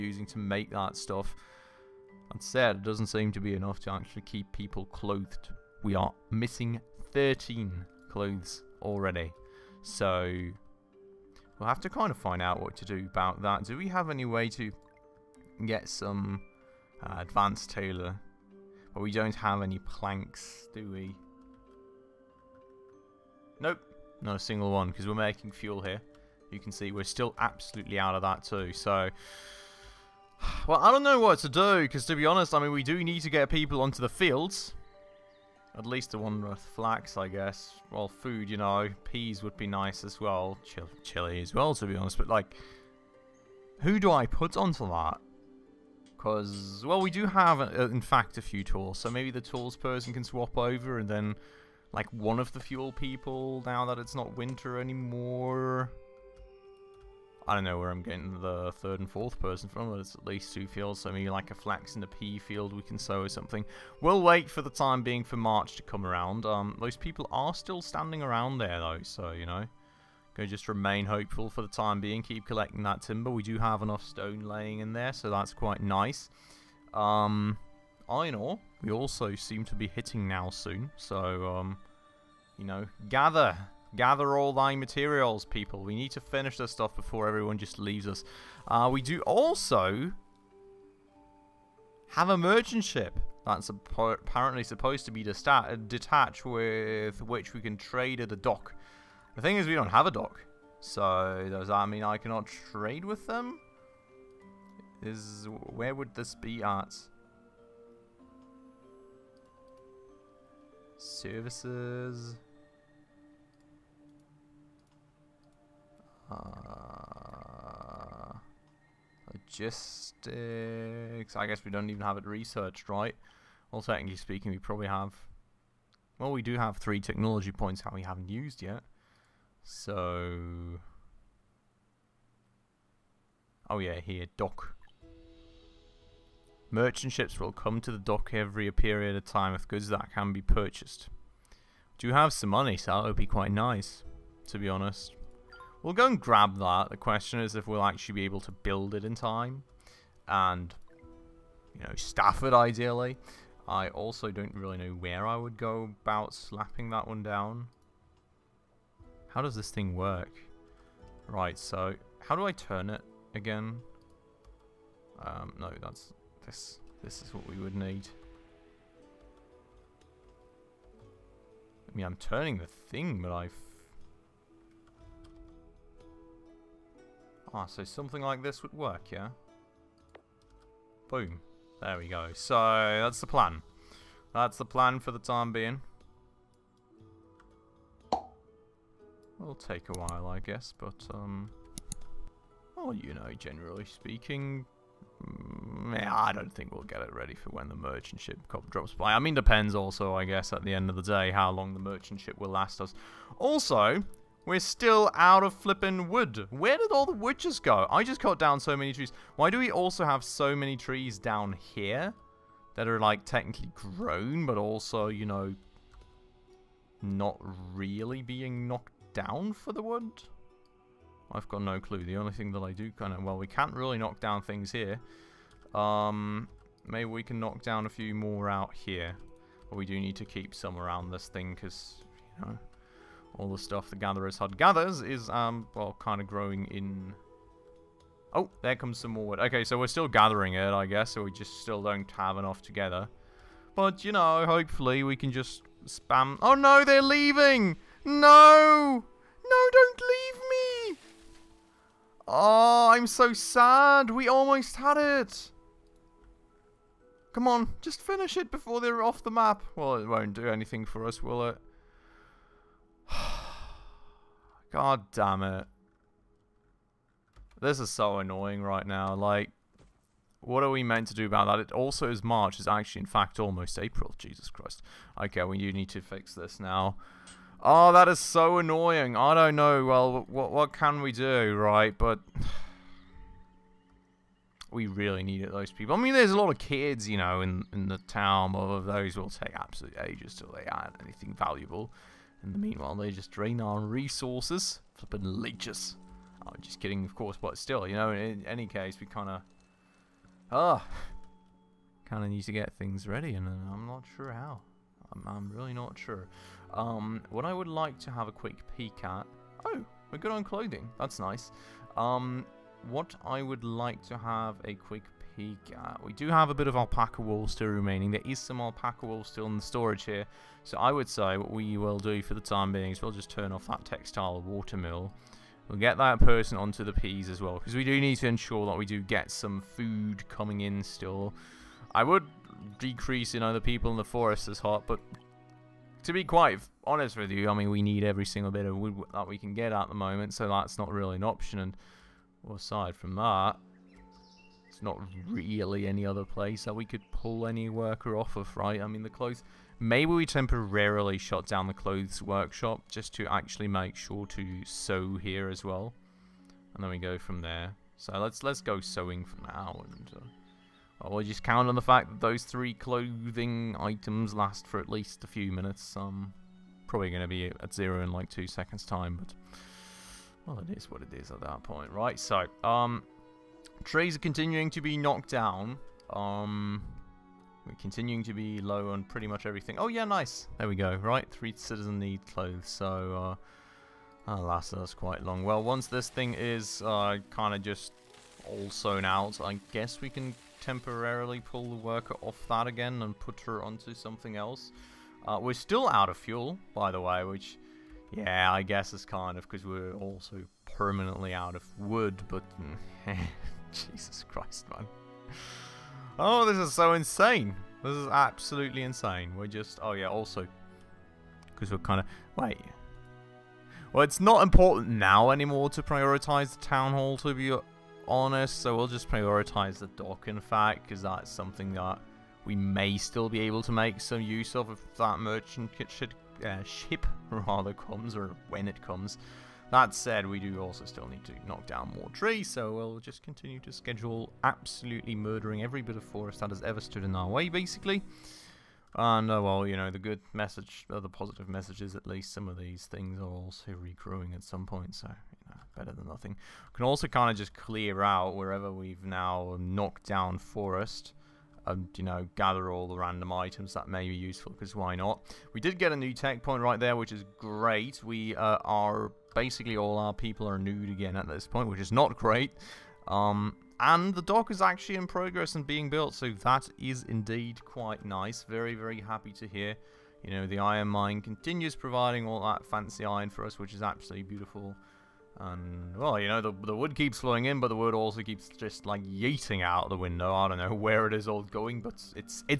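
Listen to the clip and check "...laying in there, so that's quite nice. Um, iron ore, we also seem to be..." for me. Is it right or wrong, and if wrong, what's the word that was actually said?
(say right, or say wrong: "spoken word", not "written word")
right.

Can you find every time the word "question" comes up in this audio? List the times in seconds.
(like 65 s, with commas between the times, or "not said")
146 s.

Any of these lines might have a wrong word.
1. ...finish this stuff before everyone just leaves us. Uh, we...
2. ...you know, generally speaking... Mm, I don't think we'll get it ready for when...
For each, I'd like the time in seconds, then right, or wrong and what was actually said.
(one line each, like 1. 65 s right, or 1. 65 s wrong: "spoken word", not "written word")
1. 86 s right
2. 192 s right.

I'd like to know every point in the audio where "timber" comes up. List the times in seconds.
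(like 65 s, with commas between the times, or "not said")
73 s.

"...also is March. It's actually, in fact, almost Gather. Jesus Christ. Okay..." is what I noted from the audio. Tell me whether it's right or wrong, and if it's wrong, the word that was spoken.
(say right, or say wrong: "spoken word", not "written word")
wrong: "April", not "Gather".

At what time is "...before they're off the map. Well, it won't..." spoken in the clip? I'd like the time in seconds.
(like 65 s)
258 s.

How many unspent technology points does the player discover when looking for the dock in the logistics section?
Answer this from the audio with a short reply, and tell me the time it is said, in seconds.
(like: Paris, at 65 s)
3, at 126 s.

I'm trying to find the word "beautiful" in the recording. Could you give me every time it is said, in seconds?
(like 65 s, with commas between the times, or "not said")
474 s.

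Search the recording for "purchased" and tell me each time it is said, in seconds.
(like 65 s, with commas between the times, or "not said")
140 s.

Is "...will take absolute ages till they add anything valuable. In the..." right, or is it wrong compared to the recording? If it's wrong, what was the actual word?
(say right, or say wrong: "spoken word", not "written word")
right.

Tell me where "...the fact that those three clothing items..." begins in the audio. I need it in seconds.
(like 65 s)
361 s.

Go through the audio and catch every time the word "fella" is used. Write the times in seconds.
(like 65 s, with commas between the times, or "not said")
not said.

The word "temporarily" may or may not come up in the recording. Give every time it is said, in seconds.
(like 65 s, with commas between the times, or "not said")
350 s, 390 s.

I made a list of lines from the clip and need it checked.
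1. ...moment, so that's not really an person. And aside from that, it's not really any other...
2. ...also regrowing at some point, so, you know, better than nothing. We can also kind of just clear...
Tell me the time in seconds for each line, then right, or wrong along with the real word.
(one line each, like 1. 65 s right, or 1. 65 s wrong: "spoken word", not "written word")
1. 339 s wrong: "option", not "person"
2. 443 s right.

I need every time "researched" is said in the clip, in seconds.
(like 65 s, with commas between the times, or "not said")
122 s.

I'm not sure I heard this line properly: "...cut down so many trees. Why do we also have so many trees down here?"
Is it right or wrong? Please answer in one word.
right.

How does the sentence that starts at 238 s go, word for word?
Oh, there comes some more wood.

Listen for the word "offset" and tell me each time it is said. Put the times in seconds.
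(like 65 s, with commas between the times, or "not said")
not said.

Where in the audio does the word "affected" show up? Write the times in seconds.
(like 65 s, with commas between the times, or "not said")
not said.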